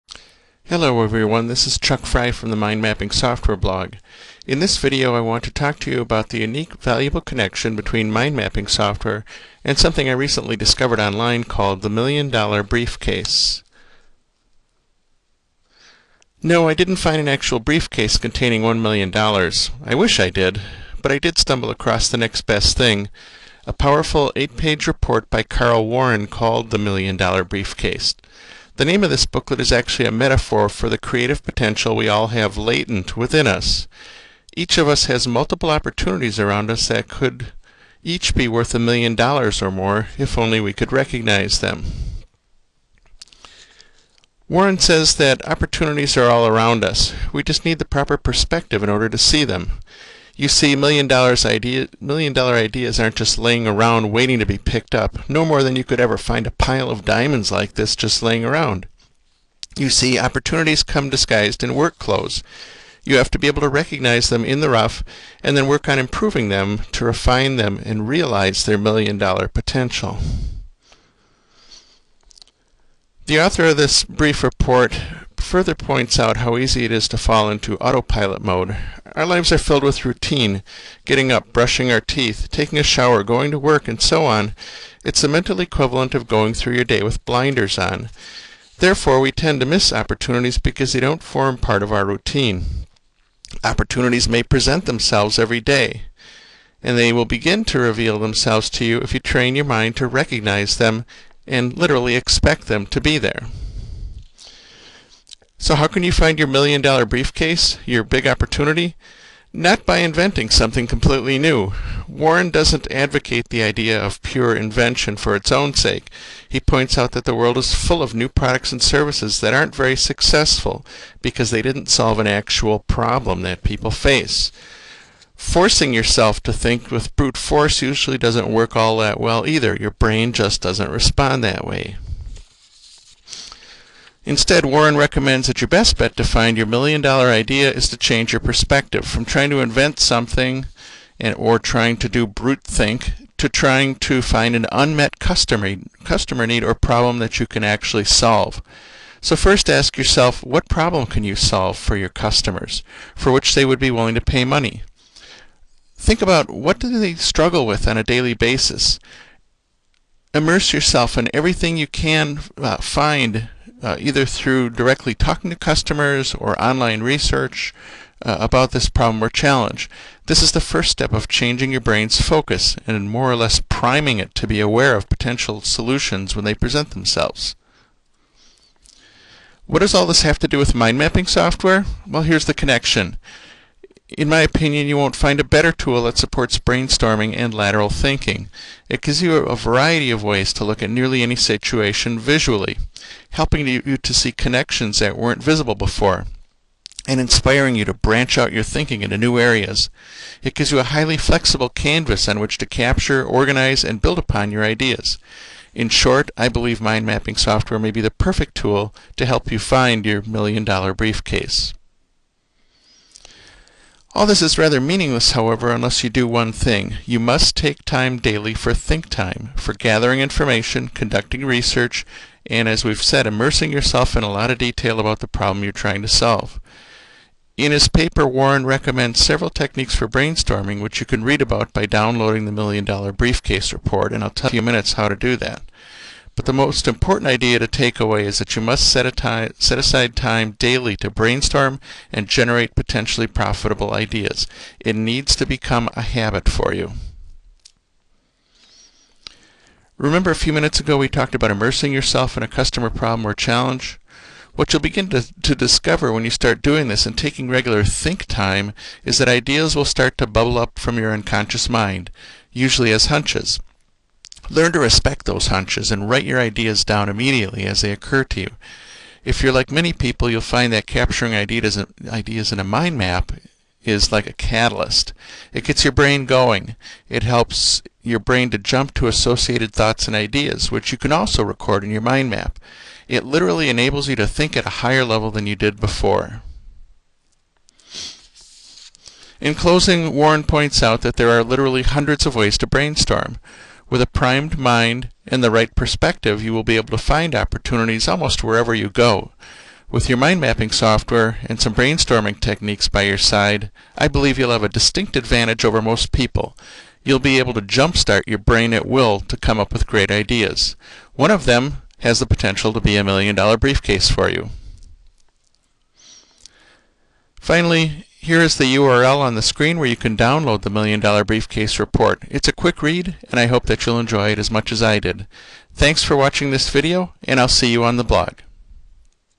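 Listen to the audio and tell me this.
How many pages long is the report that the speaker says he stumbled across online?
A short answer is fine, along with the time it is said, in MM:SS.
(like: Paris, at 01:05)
8, at 00:24.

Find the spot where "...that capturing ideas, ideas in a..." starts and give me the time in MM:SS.
04:30.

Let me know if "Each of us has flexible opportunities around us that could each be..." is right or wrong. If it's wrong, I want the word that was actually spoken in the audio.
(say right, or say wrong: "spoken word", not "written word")
wrong: "multiple", not "flexible".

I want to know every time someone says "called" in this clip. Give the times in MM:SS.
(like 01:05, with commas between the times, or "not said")
00:11, 00:26.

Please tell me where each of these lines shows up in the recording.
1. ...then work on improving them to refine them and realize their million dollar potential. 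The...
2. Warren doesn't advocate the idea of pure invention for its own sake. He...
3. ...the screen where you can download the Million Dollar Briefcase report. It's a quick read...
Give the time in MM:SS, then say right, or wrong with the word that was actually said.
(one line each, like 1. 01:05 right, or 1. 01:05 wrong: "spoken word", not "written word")
1. 01:05 right
2. 01:52 right
3. 05:19 right.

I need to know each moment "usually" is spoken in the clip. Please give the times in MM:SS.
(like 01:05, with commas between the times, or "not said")
02:07, 04:22.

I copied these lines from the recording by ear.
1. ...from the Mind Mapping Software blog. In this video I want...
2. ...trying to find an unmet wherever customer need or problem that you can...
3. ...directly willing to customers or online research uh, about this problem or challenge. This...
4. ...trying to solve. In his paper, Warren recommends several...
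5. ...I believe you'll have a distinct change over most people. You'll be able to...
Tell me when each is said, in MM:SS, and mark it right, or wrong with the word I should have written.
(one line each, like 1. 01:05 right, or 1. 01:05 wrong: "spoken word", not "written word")
1. 00:02 right
2. 02:23 wrong: "customer", not "wherever"
3. 02:44 wrong: "talking", not "willing"
4. 03:45 right
5. 05:03 wrong: "advantage", not "change".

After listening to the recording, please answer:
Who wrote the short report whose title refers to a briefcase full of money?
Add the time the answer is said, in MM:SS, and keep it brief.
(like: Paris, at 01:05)
Karl Warren, at 00:25.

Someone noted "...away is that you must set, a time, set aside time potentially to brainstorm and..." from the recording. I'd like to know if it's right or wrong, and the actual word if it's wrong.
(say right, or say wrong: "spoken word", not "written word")
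wrong: "daily", not "potentially".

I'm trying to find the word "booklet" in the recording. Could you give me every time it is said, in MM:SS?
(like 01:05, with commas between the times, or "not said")
00:29.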